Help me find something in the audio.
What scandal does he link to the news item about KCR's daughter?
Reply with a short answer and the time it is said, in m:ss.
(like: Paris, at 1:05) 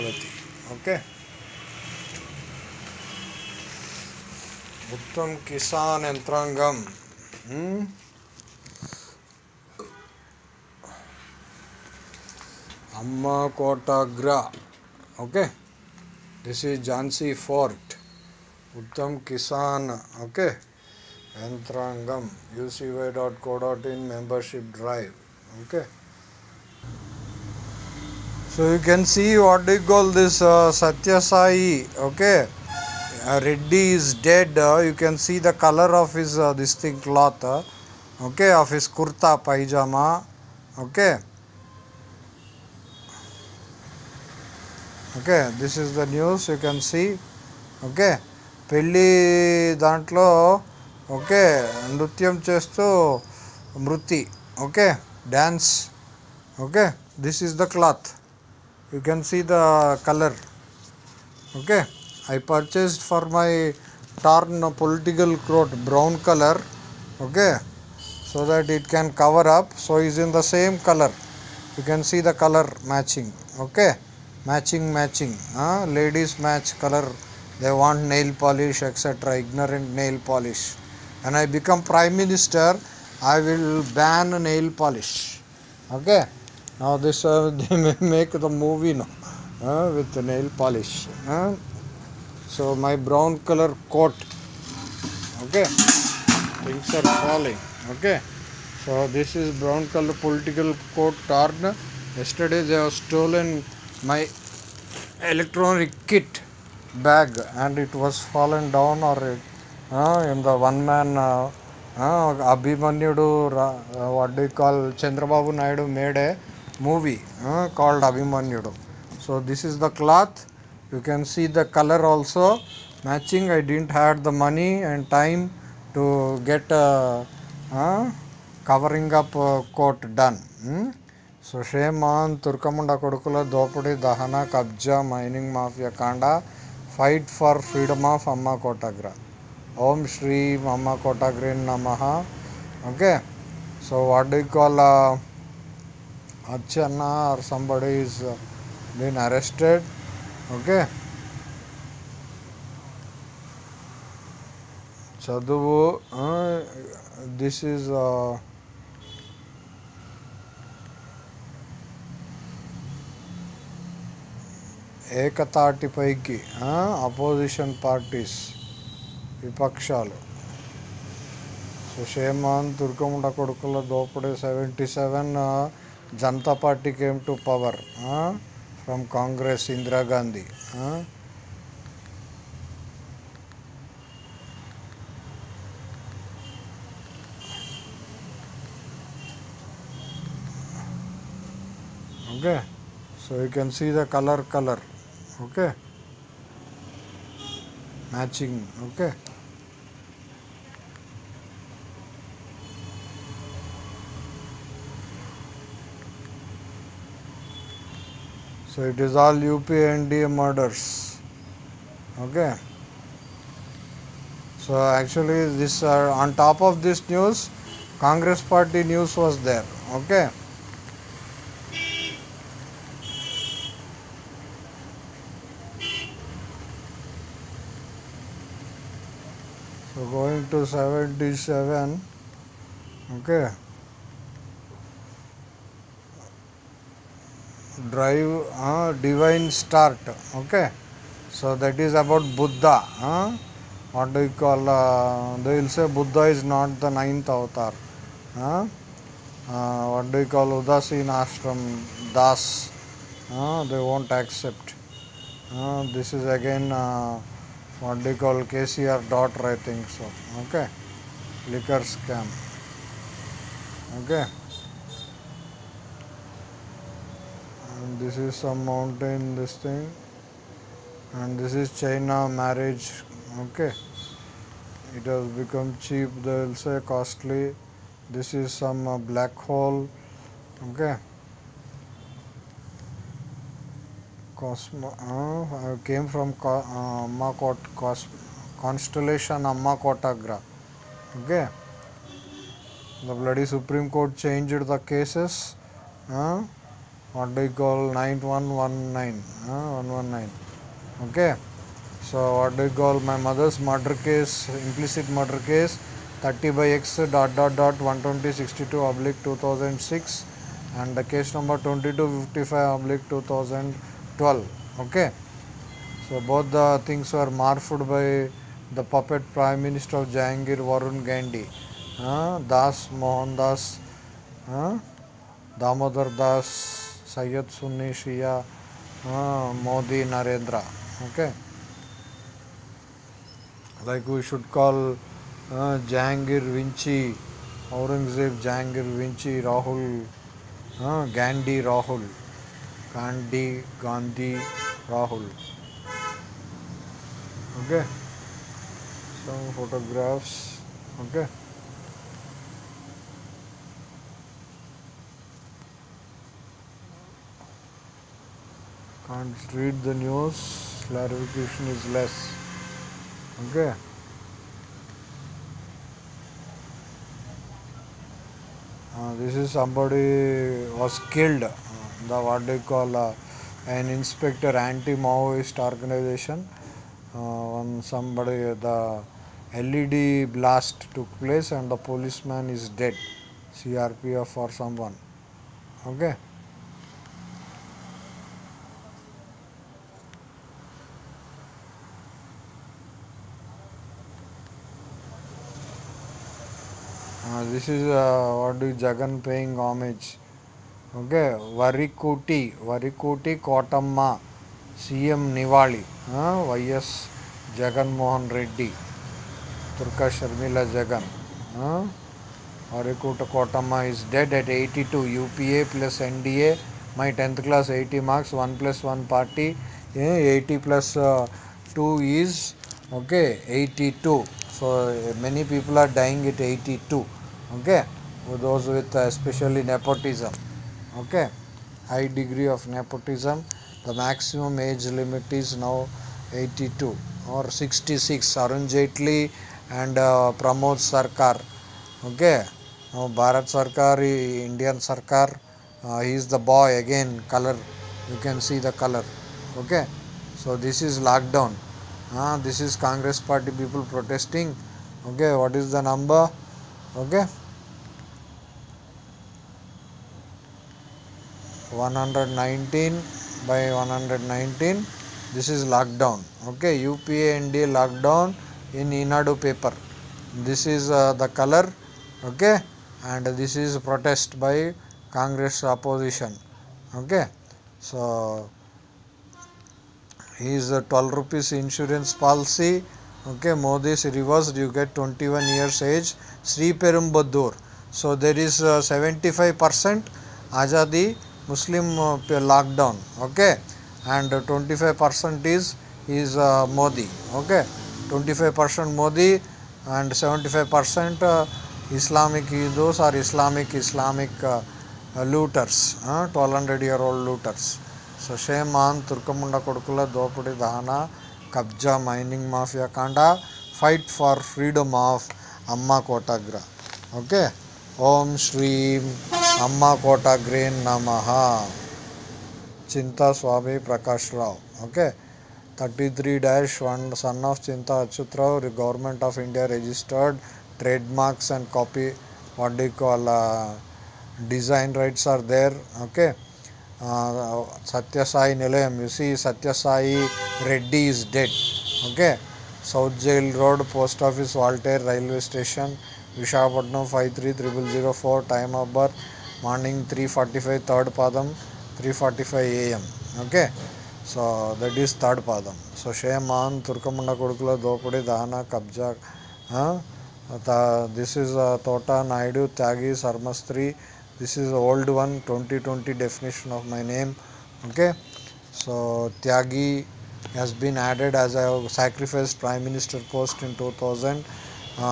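liquor scam, at 4:21.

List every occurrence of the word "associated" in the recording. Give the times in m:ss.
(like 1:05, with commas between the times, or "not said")
not said.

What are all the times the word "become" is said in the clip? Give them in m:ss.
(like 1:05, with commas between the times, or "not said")
1:21, 4:35.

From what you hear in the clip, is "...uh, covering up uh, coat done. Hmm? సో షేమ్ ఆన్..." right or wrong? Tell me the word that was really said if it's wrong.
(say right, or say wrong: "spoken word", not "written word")
right.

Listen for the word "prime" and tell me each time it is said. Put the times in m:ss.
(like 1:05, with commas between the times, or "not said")
1:21, 5:19, 9:32.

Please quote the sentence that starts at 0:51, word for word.
Okay, నృత్యం chesto, మృతి Okay, dance.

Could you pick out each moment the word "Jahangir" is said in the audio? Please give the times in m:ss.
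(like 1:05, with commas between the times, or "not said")
5:20.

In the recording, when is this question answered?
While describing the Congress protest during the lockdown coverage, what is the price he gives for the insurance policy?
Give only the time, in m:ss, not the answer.
8:00.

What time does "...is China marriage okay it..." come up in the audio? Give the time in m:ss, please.
4:31.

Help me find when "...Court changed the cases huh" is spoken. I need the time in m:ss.
4:53.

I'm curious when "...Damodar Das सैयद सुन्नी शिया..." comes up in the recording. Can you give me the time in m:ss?
5:25.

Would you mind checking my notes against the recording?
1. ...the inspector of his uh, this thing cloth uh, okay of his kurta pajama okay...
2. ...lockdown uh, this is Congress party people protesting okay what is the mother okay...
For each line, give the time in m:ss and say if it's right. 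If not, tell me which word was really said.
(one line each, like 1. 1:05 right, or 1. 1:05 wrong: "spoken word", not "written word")
1. 0:35 wrong: "color", not "inspector"
2. 7:30 wrong: "number", not "mother".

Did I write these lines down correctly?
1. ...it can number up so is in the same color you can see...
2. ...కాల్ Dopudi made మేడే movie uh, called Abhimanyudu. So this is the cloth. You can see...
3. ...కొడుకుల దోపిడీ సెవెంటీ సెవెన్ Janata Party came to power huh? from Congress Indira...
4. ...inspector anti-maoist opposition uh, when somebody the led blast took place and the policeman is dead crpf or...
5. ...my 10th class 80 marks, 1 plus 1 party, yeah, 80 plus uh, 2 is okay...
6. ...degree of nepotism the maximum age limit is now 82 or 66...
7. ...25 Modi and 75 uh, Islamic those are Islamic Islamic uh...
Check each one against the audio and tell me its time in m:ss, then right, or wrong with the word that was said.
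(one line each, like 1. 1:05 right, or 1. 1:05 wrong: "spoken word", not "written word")
1. 1:08 wrong: "cover", not "number"
2. 1:55 wrong: "Naidu", not "Dopudi"
3. 2:53 right
4. 6:13 wrong: "organization", not "opposition"
5. 6:56 right
6. 7:12 right
7. 8:18 right.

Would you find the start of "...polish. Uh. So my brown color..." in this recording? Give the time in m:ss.
1:30.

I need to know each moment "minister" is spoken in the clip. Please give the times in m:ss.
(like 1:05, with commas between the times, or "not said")
1:22, 5:19, 9:32.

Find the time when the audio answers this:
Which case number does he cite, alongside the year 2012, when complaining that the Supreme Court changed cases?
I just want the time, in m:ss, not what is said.
5:11.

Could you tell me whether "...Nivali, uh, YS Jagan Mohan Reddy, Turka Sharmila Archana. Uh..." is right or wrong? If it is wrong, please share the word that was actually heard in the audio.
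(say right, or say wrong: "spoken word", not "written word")
wrong: "Jagan", not "Archana".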